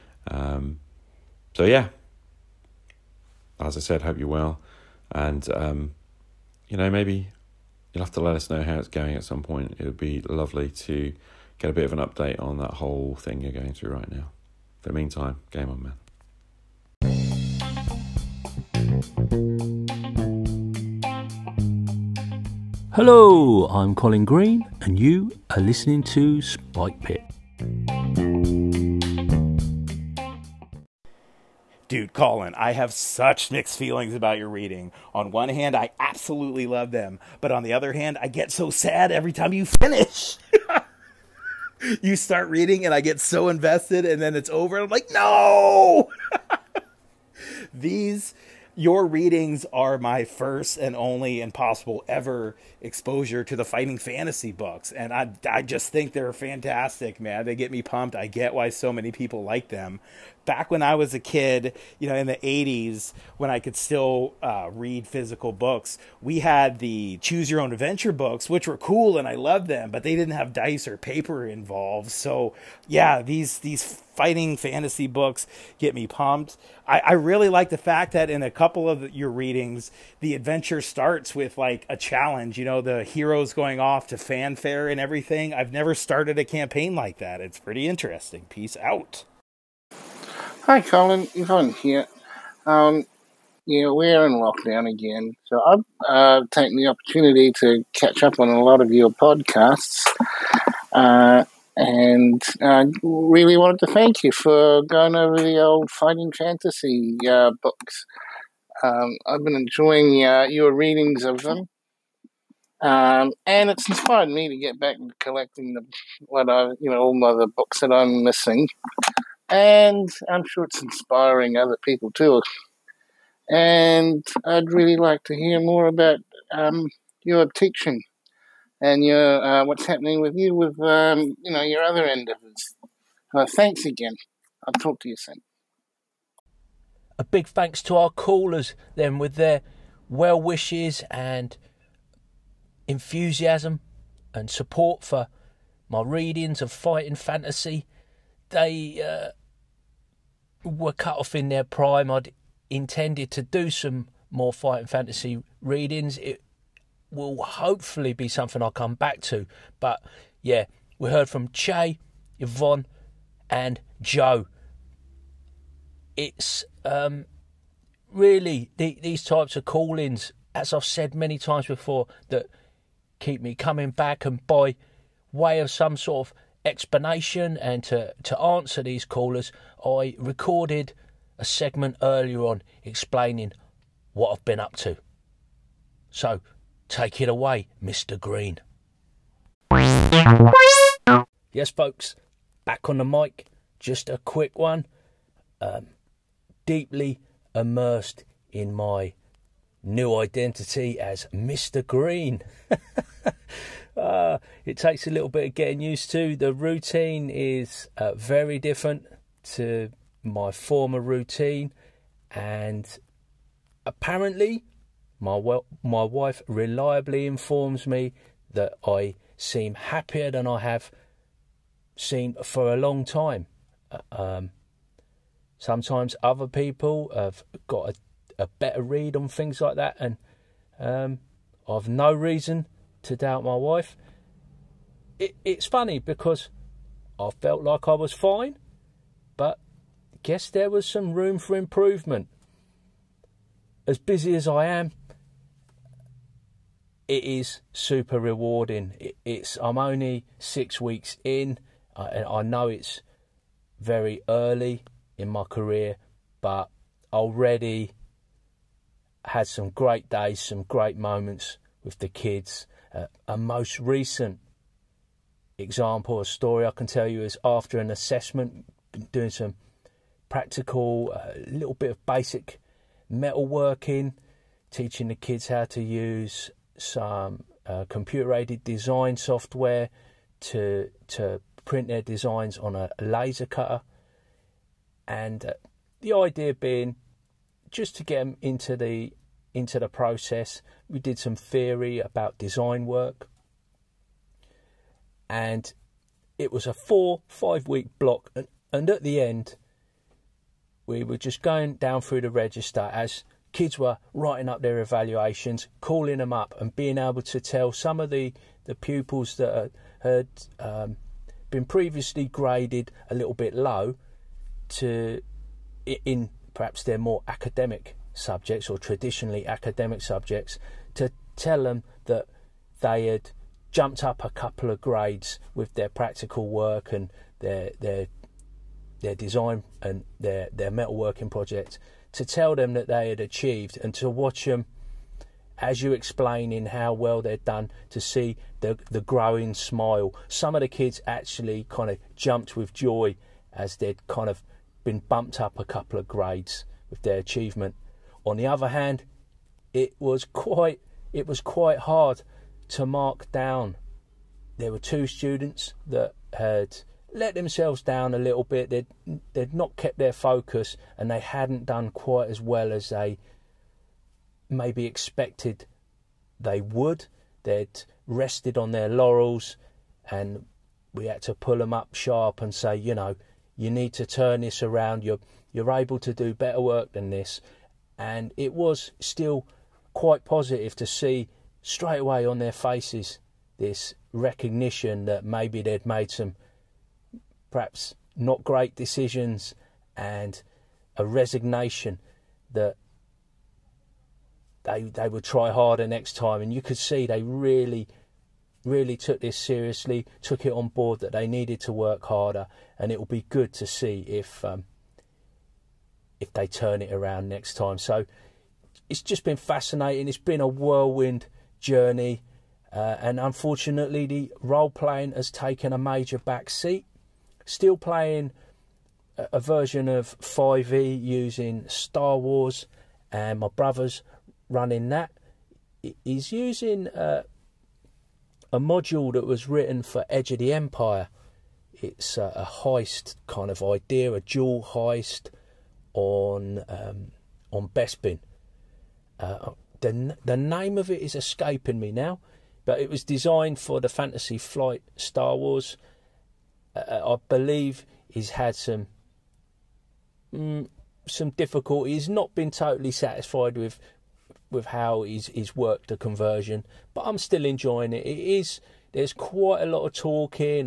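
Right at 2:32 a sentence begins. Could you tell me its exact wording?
I'd intended to do some more fight and fantasy readings.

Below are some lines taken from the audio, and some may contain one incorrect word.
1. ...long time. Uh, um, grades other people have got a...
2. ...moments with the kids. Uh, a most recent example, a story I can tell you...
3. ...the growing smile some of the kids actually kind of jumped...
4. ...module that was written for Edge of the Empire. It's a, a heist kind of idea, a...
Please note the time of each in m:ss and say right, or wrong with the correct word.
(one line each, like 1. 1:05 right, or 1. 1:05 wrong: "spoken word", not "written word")
1. 3:42 wrong: "sometimes", not "grades"
2. 4:20 right
3. 5:38 right
4. 7:08 right.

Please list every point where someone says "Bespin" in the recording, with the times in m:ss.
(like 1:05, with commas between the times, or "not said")
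7:17.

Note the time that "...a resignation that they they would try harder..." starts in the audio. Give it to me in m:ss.
6:30.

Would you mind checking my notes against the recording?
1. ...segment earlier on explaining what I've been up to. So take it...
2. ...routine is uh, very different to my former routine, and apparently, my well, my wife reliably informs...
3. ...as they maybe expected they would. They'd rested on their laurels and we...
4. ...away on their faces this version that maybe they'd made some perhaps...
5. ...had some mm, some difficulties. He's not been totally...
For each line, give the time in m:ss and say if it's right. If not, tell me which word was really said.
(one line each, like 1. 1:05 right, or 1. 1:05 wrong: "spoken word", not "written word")
1. 3:01 right
2. 3:26 right
3. 6:02 right
4. 6:21 wrong: "recognition", not "version"
5. 7:28 right.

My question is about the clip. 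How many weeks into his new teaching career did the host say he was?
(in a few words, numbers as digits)
6.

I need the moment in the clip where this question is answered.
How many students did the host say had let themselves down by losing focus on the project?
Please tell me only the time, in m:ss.
5:54.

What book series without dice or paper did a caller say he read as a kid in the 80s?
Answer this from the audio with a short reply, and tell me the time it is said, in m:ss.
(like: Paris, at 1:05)
Choose your own adventure, at 1:07.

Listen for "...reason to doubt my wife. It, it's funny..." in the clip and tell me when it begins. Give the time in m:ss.
3:52.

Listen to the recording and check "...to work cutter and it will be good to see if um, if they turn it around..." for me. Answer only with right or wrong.
wrong.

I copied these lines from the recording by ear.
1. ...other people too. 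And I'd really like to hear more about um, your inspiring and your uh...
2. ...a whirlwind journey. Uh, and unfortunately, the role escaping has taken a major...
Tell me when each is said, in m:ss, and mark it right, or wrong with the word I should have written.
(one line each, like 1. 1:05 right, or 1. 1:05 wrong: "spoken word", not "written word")
1. 2:01 wrong: "teaching", not "inspiring"
2. 6:50 wrong: "playing", not "escaping".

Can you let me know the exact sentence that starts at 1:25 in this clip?
I've never started a campaign like that.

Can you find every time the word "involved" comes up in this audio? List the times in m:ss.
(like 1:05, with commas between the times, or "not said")
1:11.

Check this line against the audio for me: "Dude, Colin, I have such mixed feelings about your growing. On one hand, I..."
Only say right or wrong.
wrong.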